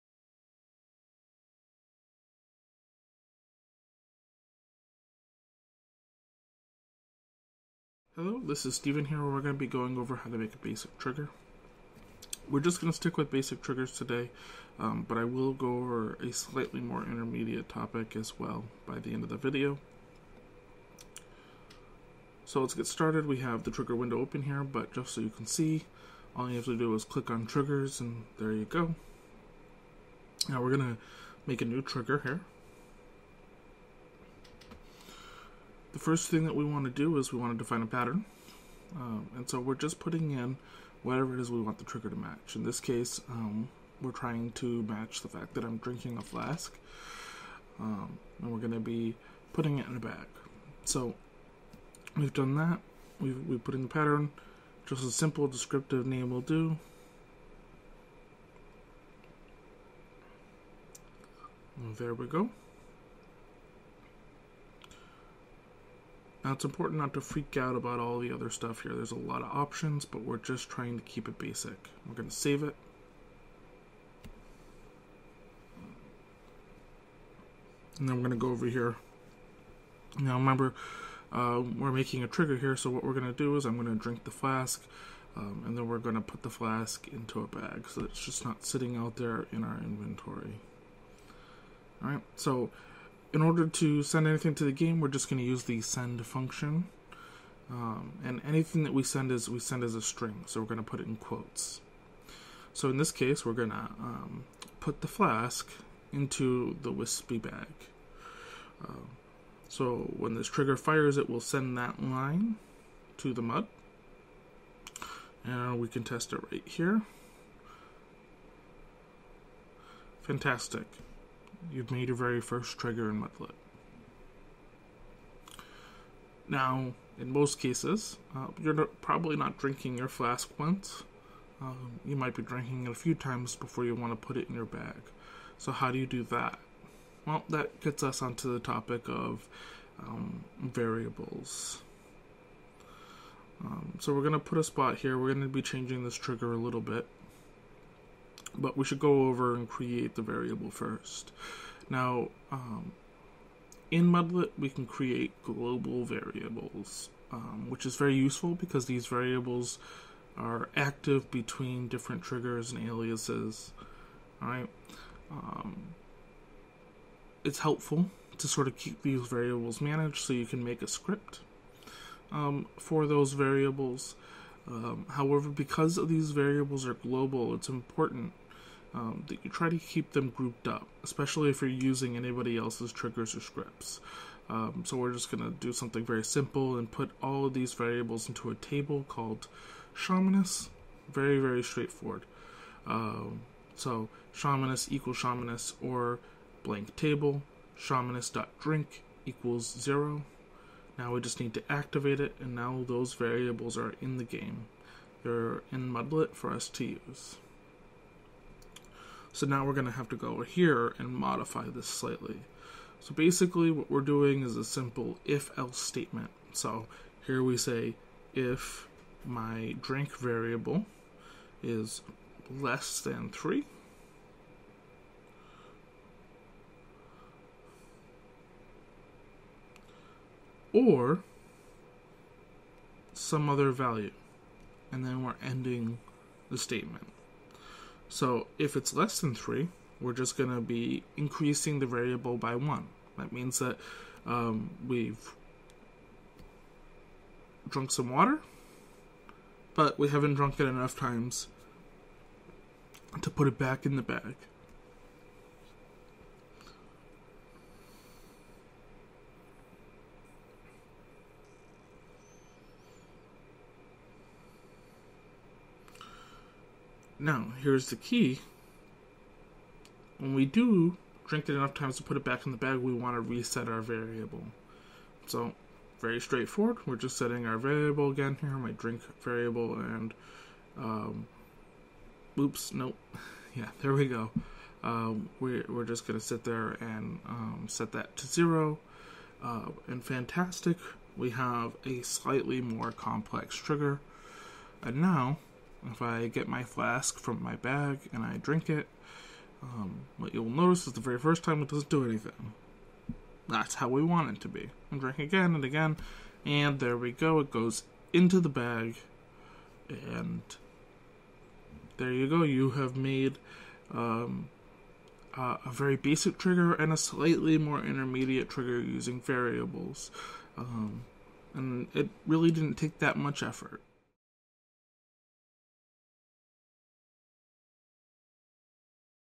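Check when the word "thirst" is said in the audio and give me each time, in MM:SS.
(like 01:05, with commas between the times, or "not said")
not said.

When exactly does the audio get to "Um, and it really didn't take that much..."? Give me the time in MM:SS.
05:20.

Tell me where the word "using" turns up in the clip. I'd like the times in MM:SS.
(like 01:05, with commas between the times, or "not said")
03:01, 05:18.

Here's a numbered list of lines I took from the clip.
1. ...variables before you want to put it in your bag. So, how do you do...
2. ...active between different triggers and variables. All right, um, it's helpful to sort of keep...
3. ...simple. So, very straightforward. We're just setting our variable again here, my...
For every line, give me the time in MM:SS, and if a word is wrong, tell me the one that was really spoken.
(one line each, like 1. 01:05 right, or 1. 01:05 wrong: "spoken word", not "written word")
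1. 02:13 wrong: "times", not "variables"
2. 02:40 wrong: "aliases", not "variables"
3. 04:33 wrong: "variable", not "simple".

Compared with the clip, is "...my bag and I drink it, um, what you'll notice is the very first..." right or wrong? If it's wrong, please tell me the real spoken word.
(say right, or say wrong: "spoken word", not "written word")
right.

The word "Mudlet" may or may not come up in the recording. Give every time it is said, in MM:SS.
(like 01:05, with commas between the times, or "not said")
02:03, 02:34, 03:25.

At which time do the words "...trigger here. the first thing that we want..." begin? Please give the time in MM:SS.
00:31.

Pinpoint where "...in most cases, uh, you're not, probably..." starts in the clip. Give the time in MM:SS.
02:07.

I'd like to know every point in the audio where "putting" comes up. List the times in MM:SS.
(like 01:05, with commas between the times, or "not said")
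00:39, 00:49.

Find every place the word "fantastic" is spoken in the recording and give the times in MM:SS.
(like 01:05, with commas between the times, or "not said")
02:00, 04:50.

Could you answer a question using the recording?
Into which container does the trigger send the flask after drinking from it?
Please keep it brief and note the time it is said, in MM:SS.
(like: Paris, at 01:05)
the wispy bag, at 01:46.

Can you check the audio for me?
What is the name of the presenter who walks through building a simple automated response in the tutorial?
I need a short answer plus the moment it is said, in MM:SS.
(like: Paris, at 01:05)
Steven, at 00:08.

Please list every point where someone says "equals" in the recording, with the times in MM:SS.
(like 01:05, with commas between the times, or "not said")
03:14, 03:19.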